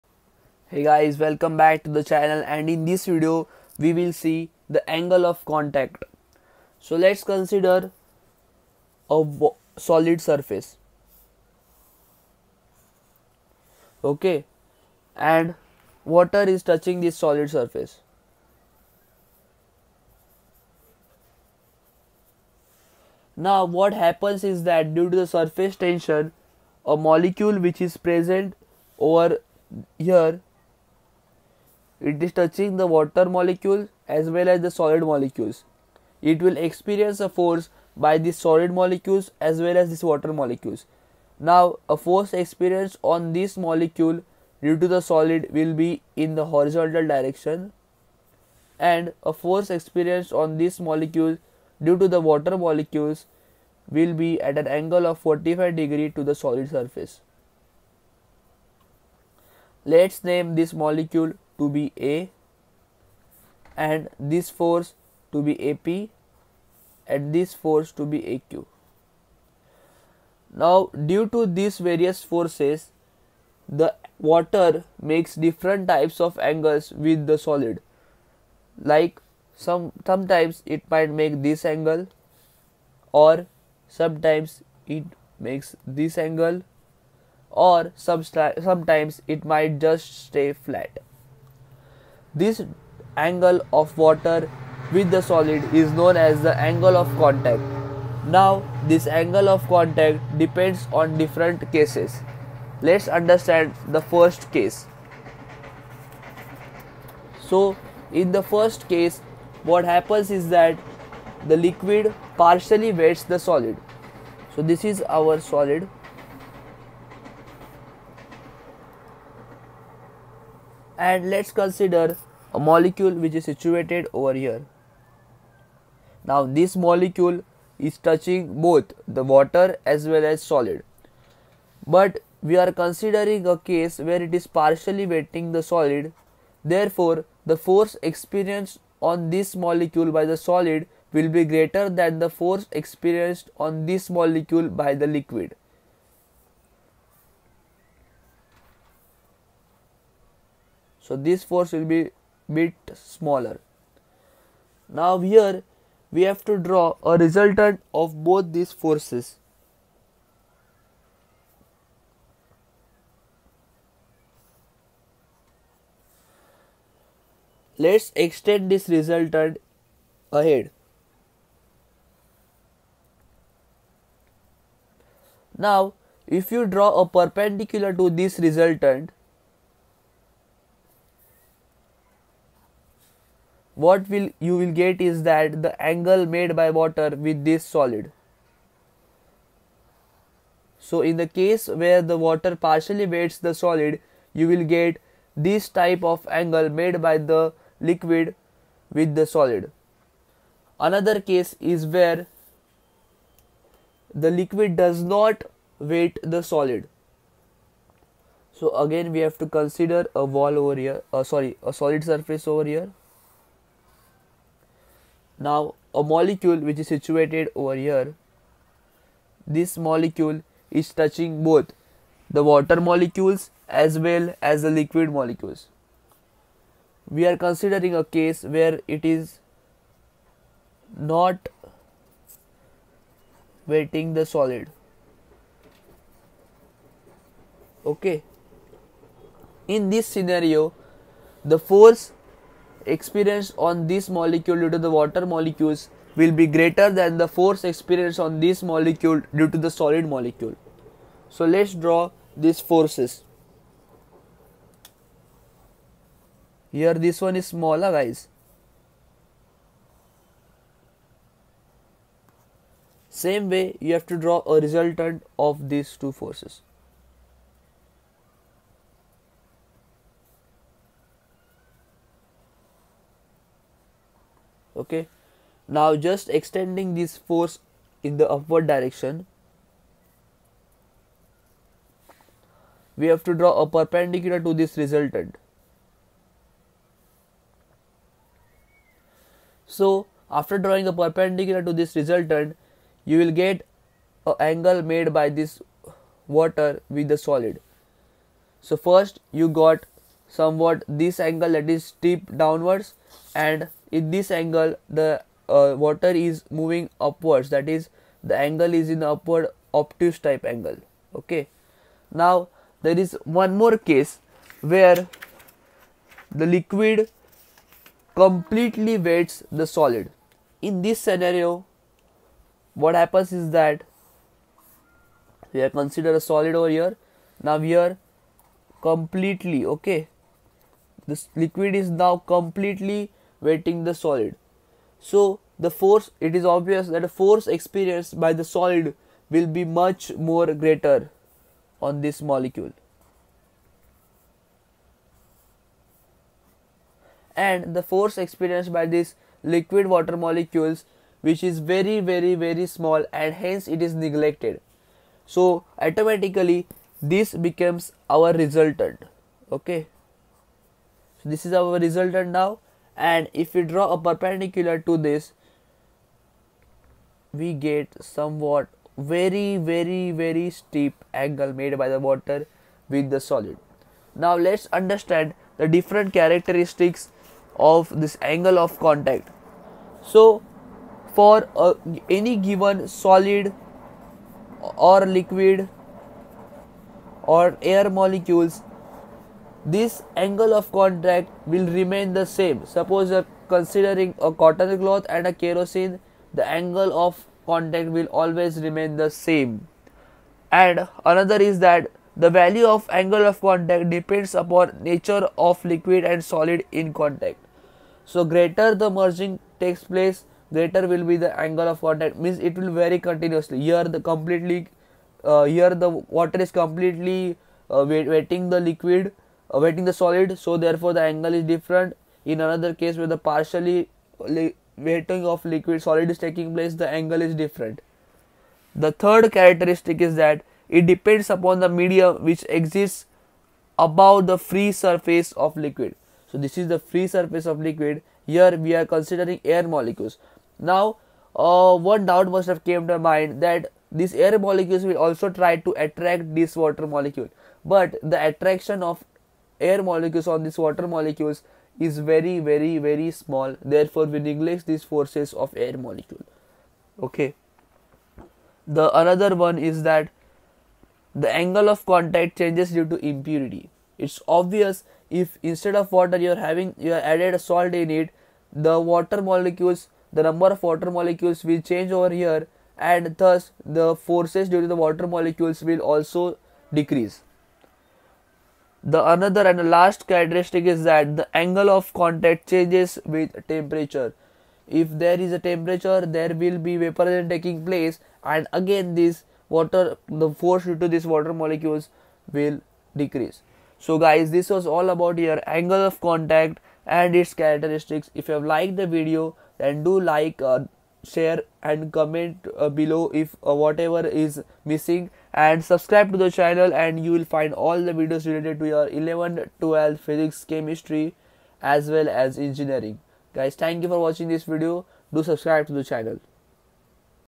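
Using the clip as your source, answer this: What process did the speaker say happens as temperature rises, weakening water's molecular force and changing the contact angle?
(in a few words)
Vaporization.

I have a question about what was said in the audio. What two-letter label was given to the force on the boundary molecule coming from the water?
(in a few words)
AQ.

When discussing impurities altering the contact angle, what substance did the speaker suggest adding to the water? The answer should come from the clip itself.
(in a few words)
Salt.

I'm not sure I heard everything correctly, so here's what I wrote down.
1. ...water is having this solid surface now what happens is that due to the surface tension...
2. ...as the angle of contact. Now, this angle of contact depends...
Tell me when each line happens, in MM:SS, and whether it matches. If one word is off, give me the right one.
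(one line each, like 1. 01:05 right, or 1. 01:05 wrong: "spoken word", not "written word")
1. 00:16 wrong: "touching", not "having"
2. 01:36 right.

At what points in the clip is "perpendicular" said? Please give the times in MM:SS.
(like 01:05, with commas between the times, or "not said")
02:57, 04:43, 04:51, 06:03.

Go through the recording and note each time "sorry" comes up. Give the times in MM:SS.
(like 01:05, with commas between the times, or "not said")
03:31.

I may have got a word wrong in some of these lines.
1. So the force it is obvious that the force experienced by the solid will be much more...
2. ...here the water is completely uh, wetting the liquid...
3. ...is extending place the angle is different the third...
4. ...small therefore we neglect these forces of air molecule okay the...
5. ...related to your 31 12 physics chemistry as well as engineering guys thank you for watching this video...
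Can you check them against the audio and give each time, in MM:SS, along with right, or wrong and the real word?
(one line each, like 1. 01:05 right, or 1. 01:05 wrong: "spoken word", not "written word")
1. 05:34 right
2. 06:55 right
3. 07:06 wrong: "taking", not "extending"
4. 07:33 right
5. 08:28 wrong: "11", not "31".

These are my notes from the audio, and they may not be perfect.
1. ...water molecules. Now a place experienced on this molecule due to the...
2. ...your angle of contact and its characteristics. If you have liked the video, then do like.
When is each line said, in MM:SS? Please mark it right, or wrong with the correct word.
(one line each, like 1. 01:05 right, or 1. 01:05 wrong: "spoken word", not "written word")
1. 00:40 wrong: "force", not "place"
2. 08:15 right.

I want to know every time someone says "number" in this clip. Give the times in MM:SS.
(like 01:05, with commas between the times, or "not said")
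07:50.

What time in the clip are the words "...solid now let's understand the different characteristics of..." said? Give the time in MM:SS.
06:13.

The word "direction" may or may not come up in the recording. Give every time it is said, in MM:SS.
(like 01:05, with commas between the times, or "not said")
00:47, 04:38.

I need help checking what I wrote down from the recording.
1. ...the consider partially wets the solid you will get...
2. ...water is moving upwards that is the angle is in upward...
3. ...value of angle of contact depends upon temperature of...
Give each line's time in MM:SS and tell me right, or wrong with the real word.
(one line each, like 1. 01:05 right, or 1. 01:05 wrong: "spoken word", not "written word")
1. 03:12 wrong: "water", not "consider"
2. 05:05 right
3. 06:42 wrong: "nature", not "temperature".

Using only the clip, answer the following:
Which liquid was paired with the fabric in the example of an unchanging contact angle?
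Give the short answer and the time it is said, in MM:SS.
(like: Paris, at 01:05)
Kerosene, at 06:35.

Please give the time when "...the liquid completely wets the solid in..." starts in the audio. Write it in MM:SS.
05:16.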